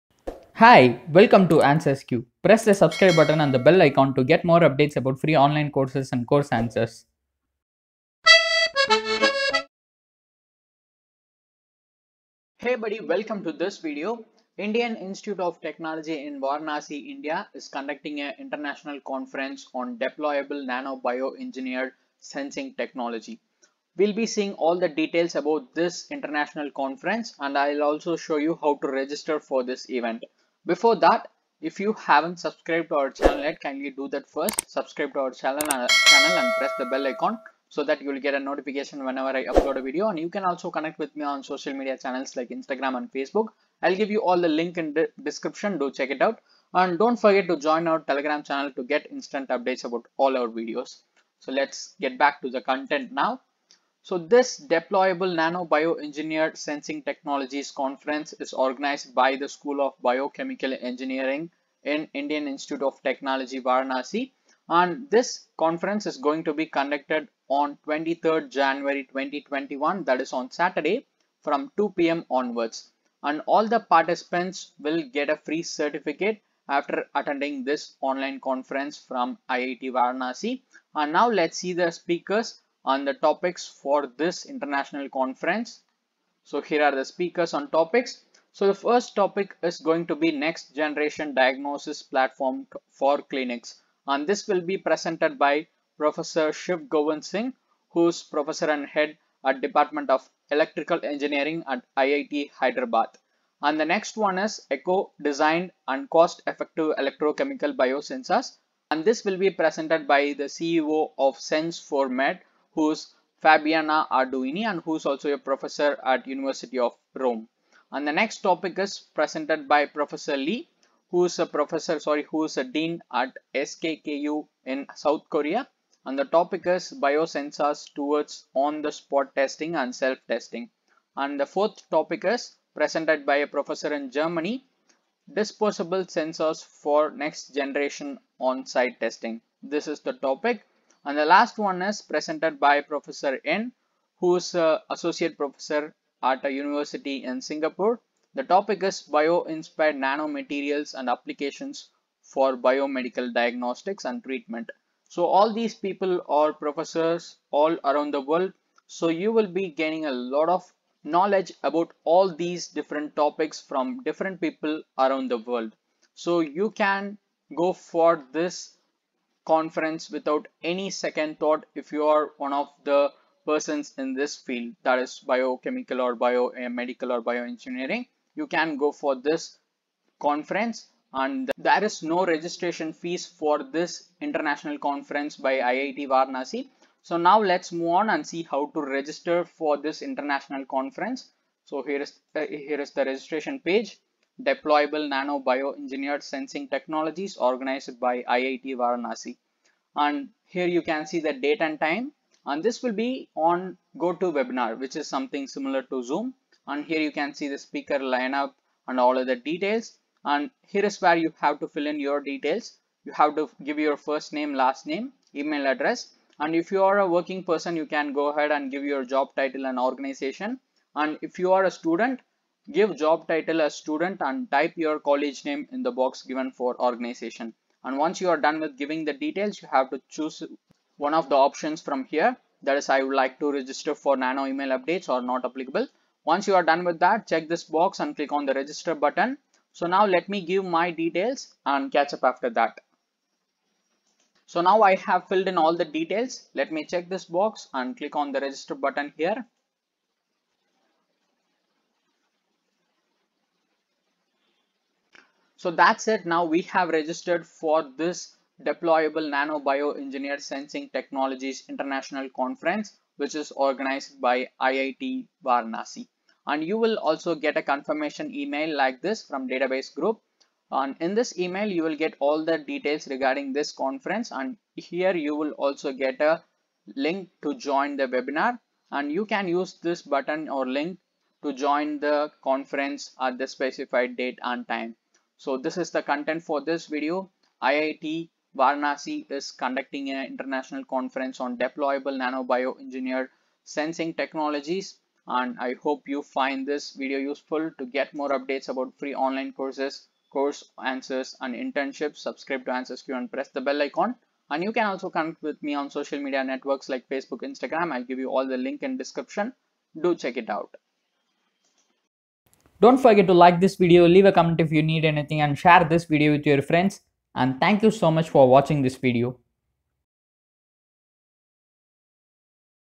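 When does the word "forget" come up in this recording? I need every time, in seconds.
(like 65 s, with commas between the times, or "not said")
47 s, 312 s.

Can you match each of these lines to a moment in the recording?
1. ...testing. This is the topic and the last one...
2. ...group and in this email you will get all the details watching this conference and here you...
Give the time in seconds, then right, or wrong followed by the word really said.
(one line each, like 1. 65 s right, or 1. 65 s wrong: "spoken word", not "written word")
1. 139 s right
2. 269 s wrong: "regarding", not "watching".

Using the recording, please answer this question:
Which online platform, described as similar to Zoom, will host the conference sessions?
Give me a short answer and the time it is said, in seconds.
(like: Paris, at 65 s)
GoToWebinar, at 203 s.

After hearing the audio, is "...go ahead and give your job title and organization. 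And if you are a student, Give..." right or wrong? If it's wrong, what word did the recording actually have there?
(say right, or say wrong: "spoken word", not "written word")
right.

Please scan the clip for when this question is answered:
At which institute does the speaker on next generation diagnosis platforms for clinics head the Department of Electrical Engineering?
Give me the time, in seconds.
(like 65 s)
101 s.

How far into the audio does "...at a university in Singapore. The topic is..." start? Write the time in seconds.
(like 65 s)
146 s.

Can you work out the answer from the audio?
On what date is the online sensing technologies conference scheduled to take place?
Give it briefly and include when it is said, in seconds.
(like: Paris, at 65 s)
23 January 2021, at 67 s.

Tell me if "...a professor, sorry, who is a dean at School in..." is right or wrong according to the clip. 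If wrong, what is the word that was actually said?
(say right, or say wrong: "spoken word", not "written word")
wrong: "SKKU", not "School".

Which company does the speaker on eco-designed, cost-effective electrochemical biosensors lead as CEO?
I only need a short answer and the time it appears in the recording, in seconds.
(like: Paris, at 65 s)
Sense4Med, at 111 s.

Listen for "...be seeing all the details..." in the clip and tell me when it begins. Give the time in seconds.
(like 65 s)
24 s.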